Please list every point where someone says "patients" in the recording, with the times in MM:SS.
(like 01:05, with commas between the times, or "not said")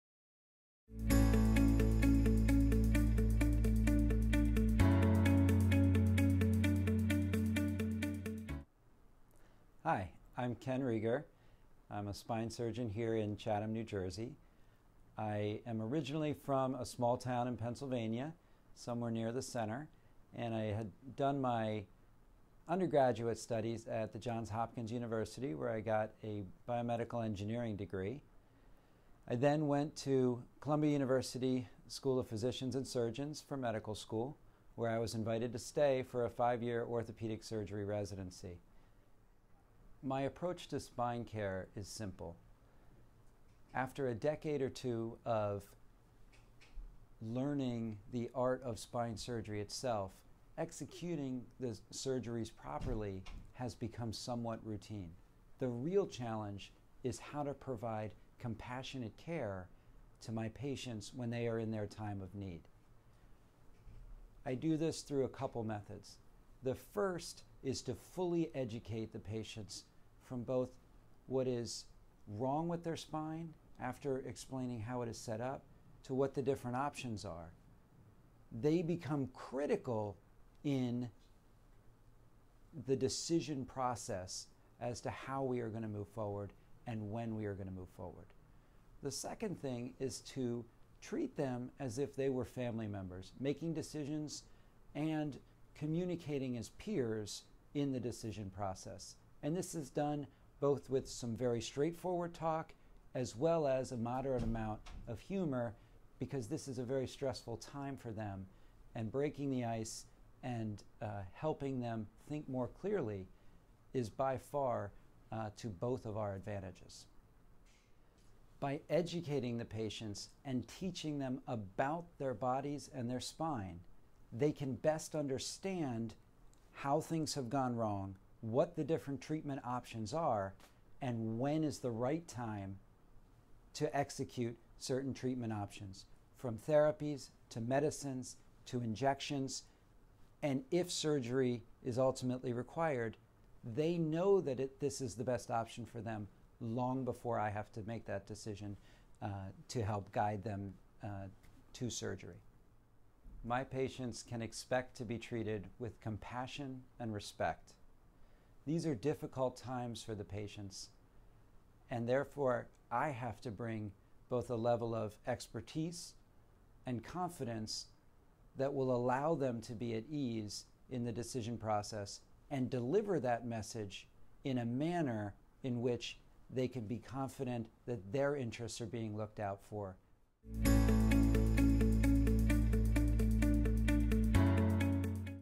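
01:00, 01:09, 01:59, 02:33, 02:40.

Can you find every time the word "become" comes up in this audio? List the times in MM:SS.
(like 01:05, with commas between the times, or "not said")
00:53, 01:18.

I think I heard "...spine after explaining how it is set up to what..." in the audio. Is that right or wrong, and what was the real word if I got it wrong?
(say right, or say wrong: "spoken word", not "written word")
right.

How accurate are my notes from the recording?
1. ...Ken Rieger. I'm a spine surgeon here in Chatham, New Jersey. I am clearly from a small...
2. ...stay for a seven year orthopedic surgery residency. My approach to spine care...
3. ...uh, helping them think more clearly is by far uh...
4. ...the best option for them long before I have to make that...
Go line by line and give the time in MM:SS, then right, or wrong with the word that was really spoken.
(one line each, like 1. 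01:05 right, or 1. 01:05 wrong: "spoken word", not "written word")
1. 00:10 wrong: "originally", not "clearly"
2. 00:35 wrong: "five", not "seven"
3. 01:51 right
4. 02:25 right.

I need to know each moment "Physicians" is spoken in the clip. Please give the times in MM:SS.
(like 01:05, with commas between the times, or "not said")
00:32.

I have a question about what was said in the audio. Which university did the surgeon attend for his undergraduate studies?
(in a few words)
Johns Hopkins University.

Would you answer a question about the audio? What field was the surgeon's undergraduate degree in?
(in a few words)
Biomedical engineering.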